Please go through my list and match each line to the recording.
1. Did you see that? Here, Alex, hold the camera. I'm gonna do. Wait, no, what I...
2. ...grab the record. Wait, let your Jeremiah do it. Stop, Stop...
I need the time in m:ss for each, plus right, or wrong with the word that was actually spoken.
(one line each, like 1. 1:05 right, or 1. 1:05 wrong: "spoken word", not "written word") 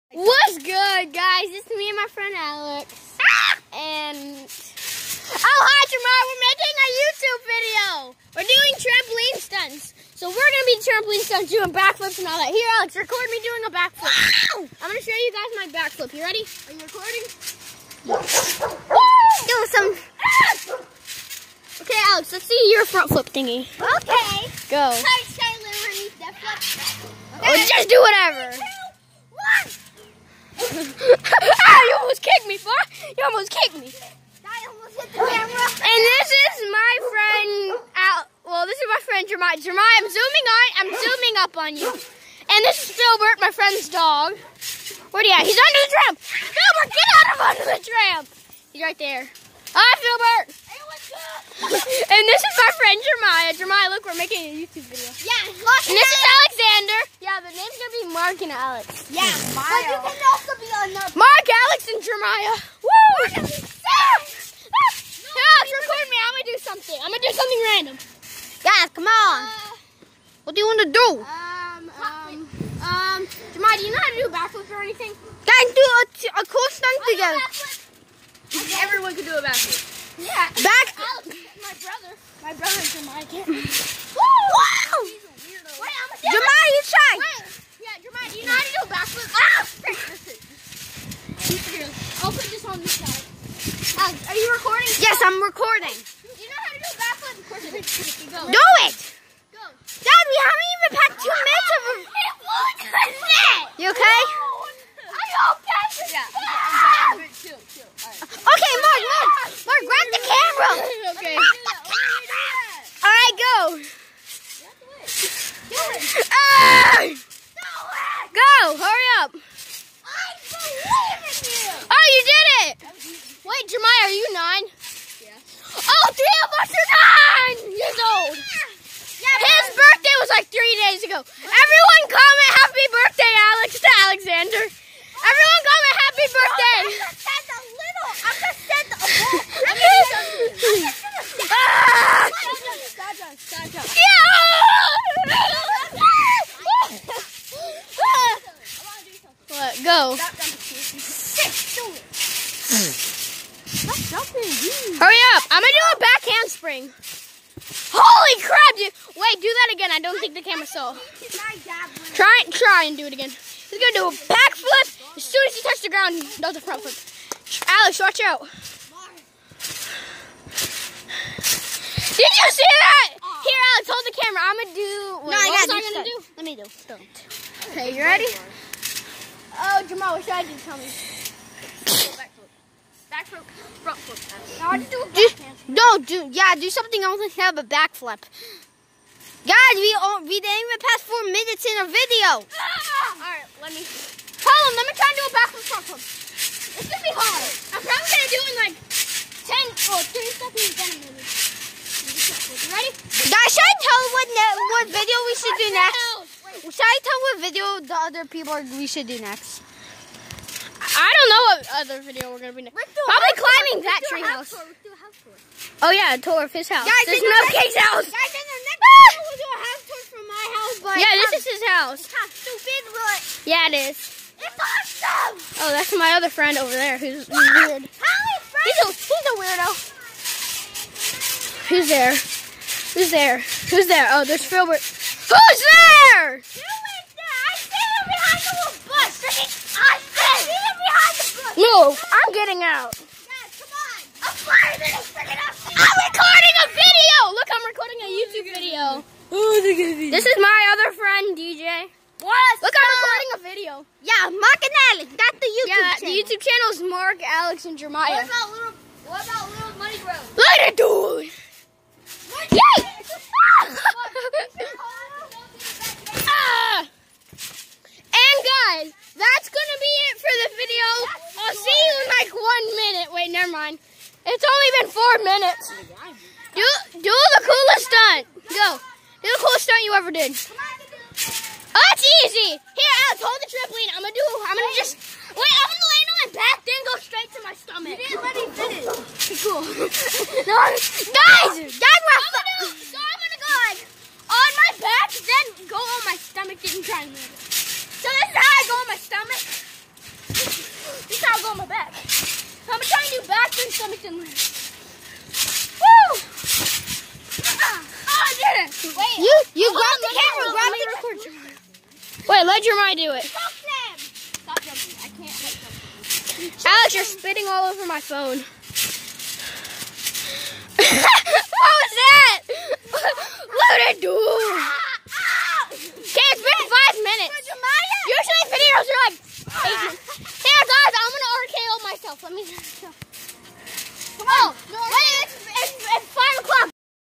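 1. 2:51 right
2. 5:10 right.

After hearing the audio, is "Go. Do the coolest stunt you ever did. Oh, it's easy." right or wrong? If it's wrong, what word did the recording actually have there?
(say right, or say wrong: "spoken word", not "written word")
right.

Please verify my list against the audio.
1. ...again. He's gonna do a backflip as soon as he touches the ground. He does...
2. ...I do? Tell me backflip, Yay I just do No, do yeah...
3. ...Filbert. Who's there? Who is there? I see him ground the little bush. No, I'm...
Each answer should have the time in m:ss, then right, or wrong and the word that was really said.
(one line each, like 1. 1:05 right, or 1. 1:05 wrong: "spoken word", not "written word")
1. 2:43 right
2. 3:00 wrong: "Now", not "Yay"
3. 3:54 wrong: "behind", not "ground".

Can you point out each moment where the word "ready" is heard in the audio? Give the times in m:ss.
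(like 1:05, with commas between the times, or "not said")
0:16, 2:58, 3:22.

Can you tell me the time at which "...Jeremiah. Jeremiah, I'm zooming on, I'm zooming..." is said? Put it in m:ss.
0:39.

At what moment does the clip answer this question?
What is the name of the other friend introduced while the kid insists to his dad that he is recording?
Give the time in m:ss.
4:11.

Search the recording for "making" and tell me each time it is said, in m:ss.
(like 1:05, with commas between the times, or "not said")
0:06, 0:54.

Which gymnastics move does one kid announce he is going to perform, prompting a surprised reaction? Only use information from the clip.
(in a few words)
Back handspring.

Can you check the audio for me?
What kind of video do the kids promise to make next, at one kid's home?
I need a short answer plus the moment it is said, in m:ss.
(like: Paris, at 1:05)
A house tour, at 3:39.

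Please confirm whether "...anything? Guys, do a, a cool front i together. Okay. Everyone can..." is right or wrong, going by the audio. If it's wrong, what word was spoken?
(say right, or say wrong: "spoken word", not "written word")
wrong: "stunt", not "front".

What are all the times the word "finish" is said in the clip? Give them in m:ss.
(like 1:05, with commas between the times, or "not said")
4:48.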